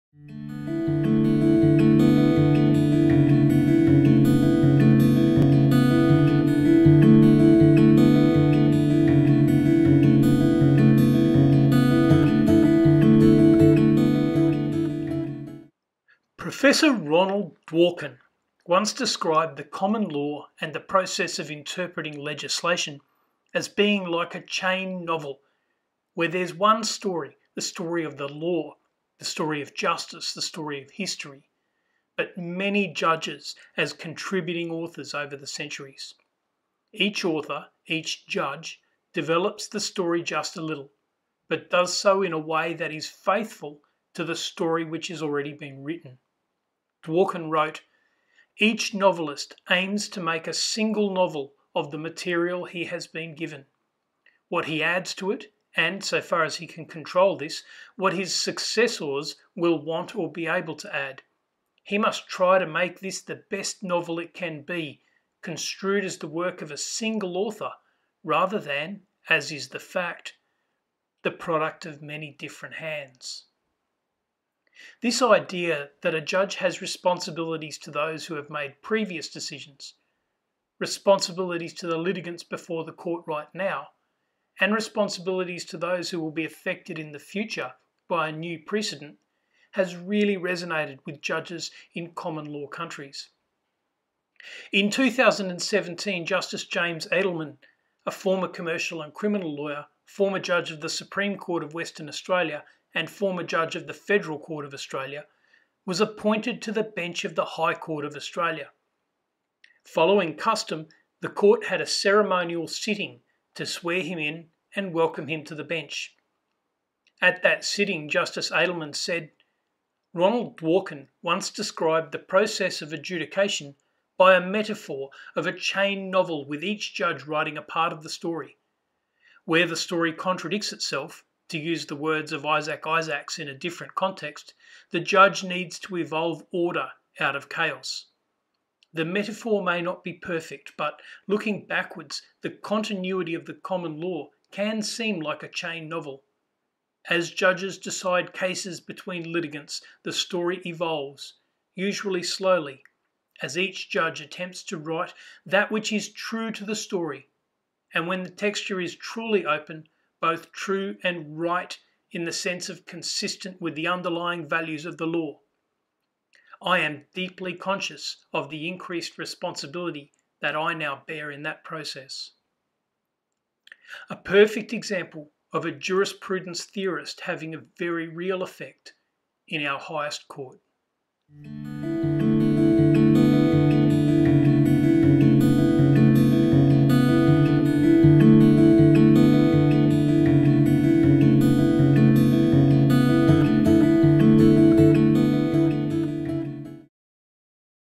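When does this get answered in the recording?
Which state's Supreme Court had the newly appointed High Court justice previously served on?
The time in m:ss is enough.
1:41.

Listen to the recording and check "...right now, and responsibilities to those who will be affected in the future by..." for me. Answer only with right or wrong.
right.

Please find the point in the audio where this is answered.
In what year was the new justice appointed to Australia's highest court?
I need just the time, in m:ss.
1:34.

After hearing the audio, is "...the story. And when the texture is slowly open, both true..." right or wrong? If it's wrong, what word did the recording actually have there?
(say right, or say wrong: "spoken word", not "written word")
wrong: "truly", not "slowly".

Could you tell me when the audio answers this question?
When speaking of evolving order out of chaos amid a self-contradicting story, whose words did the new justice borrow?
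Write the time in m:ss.
2:12.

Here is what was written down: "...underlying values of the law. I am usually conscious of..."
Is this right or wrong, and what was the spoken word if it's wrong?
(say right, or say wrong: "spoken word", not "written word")
wrong: "deeply", not "usually".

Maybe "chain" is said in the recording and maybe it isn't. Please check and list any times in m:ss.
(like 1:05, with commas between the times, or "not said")
0:24, 2:05, 2:25.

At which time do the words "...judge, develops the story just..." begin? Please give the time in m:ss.
0:38.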